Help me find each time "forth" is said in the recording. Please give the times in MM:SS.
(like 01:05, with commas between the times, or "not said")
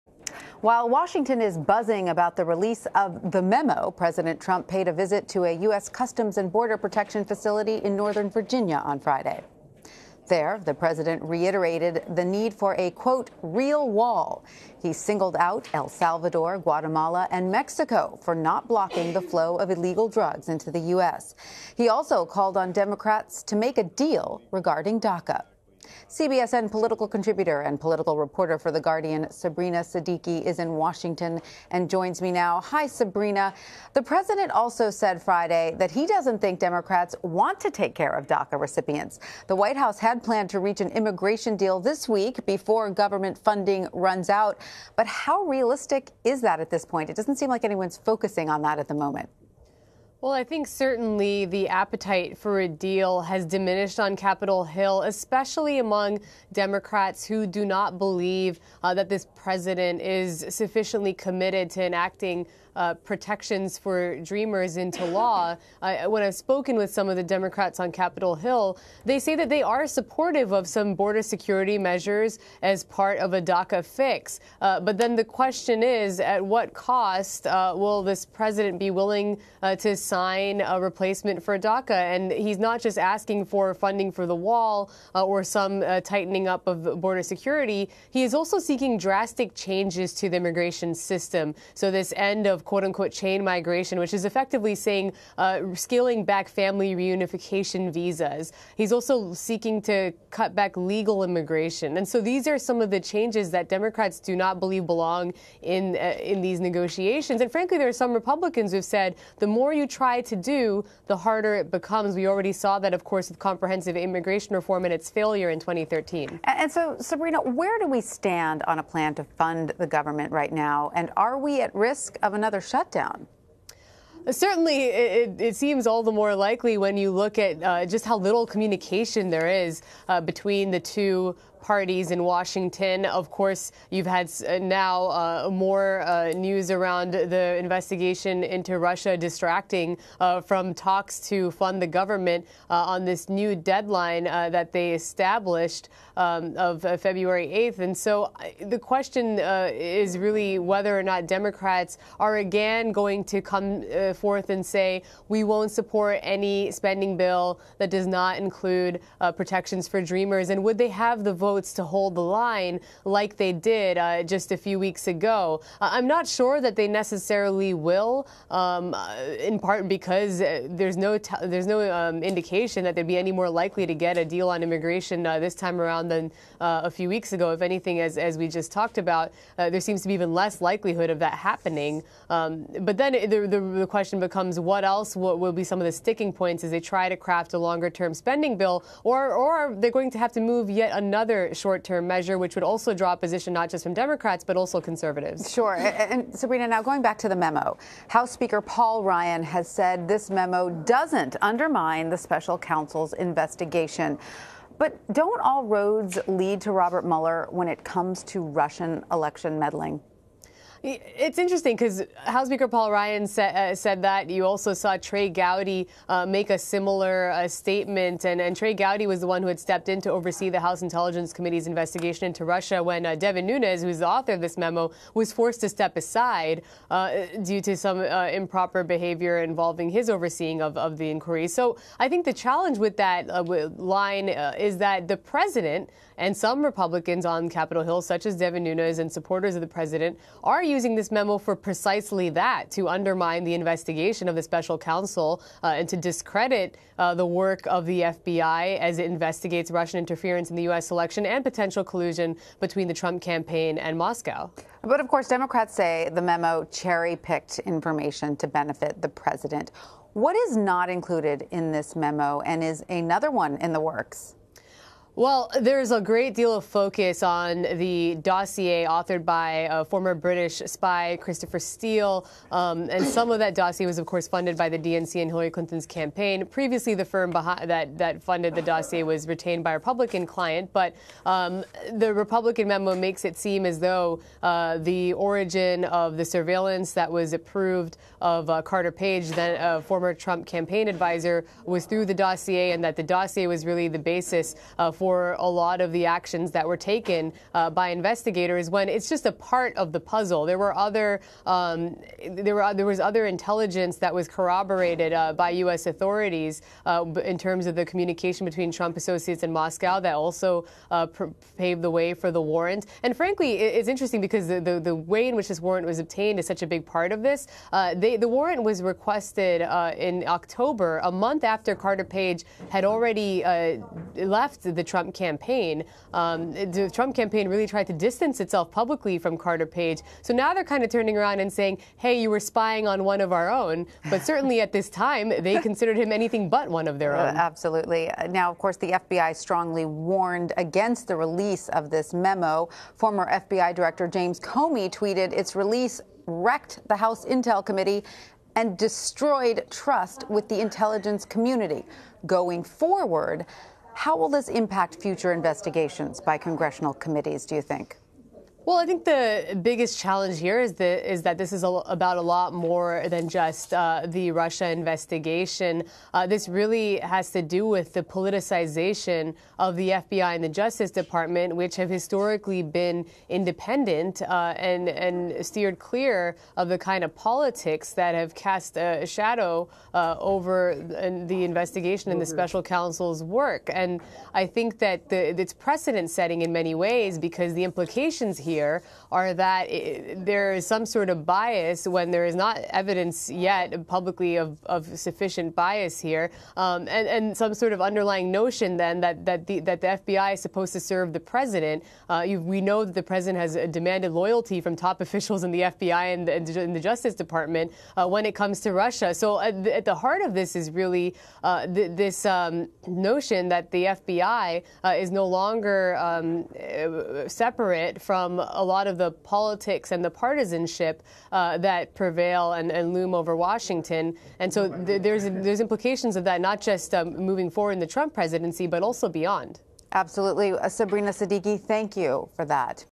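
02:34.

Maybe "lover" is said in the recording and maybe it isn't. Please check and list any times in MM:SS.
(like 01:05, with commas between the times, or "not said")
not said.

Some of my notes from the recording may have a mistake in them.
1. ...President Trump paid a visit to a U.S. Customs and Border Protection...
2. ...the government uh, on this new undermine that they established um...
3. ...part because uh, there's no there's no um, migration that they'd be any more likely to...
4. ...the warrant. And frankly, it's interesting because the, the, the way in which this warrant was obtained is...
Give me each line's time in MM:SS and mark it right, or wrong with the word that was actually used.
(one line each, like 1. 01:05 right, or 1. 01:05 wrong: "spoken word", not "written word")
1. 00:03 right
2. 02:21 wrong: "deadline", not "undermine"
3. 02:49 wrong: "indication", not "migration"
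4. 05:12 right.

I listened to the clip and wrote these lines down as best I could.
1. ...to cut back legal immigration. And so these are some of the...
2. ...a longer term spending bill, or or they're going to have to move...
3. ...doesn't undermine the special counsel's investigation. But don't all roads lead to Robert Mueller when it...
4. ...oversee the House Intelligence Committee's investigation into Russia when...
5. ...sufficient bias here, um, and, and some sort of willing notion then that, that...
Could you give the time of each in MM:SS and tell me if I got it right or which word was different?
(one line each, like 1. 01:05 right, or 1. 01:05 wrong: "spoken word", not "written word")
1. 01:39 right
2. 03:07 right
3. 03:20 right
4. 03:40 right
5. 06:34 wrong: "underlying", not "willing".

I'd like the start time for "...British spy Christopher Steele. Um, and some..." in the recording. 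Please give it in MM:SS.
04:30.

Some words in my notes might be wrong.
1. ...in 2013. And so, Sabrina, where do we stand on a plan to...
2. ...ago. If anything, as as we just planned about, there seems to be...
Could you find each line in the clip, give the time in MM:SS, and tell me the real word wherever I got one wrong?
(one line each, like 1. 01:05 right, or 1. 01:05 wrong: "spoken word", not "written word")
1. 01:55 right
2. 02:57 wrong: "talked", not "planned".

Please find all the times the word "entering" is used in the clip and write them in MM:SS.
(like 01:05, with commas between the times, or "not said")
not said.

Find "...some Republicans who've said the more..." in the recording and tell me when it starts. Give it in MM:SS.
01:47.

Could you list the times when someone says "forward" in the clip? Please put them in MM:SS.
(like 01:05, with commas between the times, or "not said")
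05:52, 07:07.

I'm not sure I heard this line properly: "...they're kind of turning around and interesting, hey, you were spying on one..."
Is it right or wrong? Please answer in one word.
wrong.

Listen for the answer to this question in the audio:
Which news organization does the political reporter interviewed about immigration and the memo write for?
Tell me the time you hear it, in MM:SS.
00:28.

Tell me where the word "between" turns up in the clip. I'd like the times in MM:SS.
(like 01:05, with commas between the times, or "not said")
02:10, 04:12, 05:08.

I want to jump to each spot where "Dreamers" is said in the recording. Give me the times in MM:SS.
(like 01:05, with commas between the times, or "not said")
01:04, 02:40.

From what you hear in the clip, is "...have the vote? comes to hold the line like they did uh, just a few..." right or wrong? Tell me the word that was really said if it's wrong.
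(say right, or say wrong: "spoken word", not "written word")
wrong: "votes", not "comes".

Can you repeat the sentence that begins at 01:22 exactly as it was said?
And he's not just asking for funding for the wall uh, or some uh, tightening up of border security.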